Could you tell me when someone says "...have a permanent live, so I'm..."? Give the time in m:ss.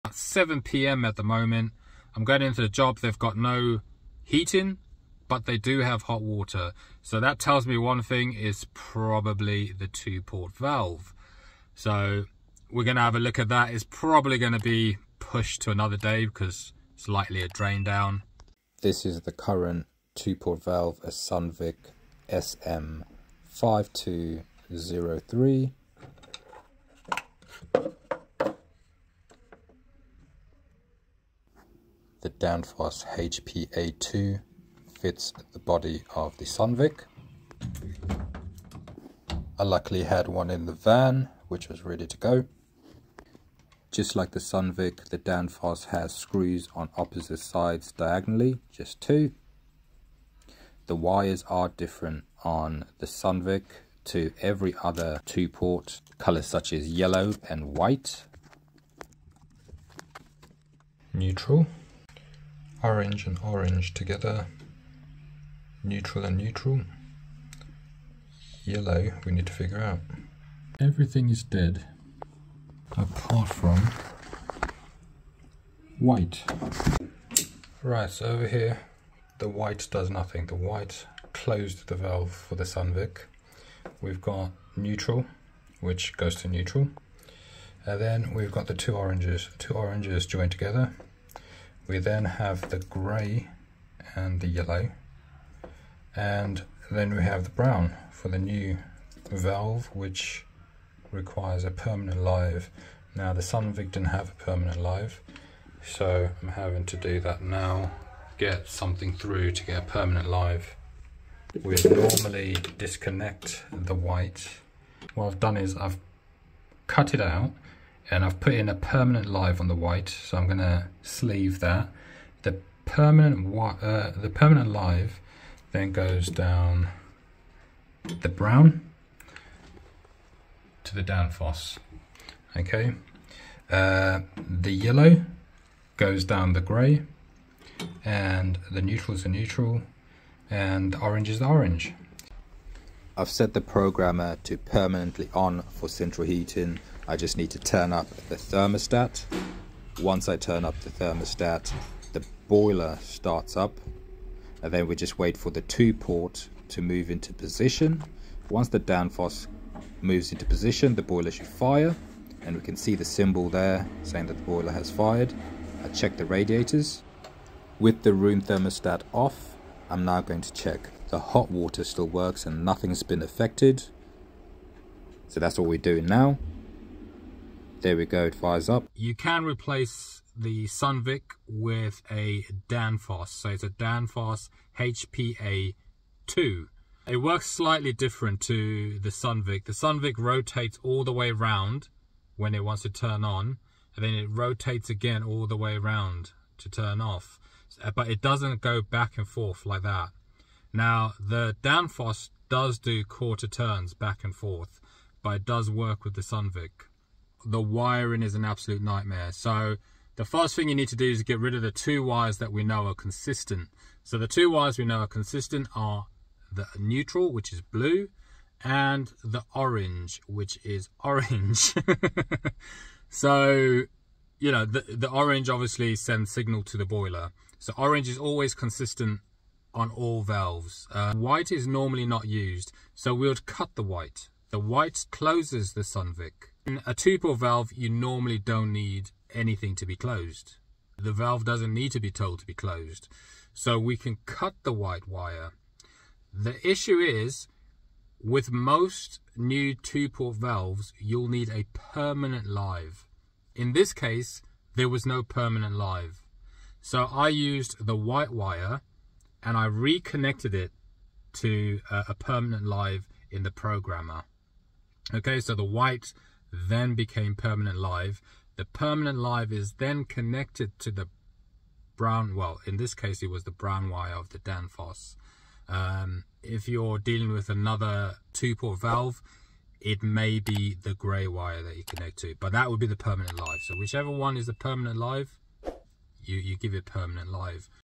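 1:44.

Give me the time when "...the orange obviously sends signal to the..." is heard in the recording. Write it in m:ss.
3:44.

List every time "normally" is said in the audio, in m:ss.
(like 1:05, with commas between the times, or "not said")
1:51, 3:51, 3:57.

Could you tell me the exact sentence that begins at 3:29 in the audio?
So the first thing you need to do is get rid of the two wires that we know are consistent.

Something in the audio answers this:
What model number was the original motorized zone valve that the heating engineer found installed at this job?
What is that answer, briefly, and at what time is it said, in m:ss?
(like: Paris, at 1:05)
SM5203, at 0:21.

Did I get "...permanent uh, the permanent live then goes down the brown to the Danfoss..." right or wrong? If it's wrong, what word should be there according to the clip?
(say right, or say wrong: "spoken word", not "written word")
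right.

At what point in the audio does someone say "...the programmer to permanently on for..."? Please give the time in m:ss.
2:23.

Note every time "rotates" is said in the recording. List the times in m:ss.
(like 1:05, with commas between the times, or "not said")
3:10, 3:14.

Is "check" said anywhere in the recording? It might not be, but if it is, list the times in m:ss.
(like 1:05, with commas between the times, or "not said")
2:45, 2:50.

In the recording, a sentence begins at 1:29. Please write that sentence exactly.
Two oranges joined together, we then have the grey and the yellow.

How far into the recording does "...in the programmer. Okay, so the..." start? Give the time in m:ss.
4:23.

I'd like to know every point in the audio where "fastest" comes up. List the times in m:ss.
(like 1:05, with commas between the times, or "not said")
not said.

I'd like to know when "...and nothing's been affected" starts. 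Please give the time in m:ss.
2:52.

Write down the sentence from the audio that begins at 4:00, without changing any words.
The valve doesn't need to be told to be closed.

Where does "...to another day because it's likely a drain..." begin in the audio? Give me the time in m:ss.
0:15.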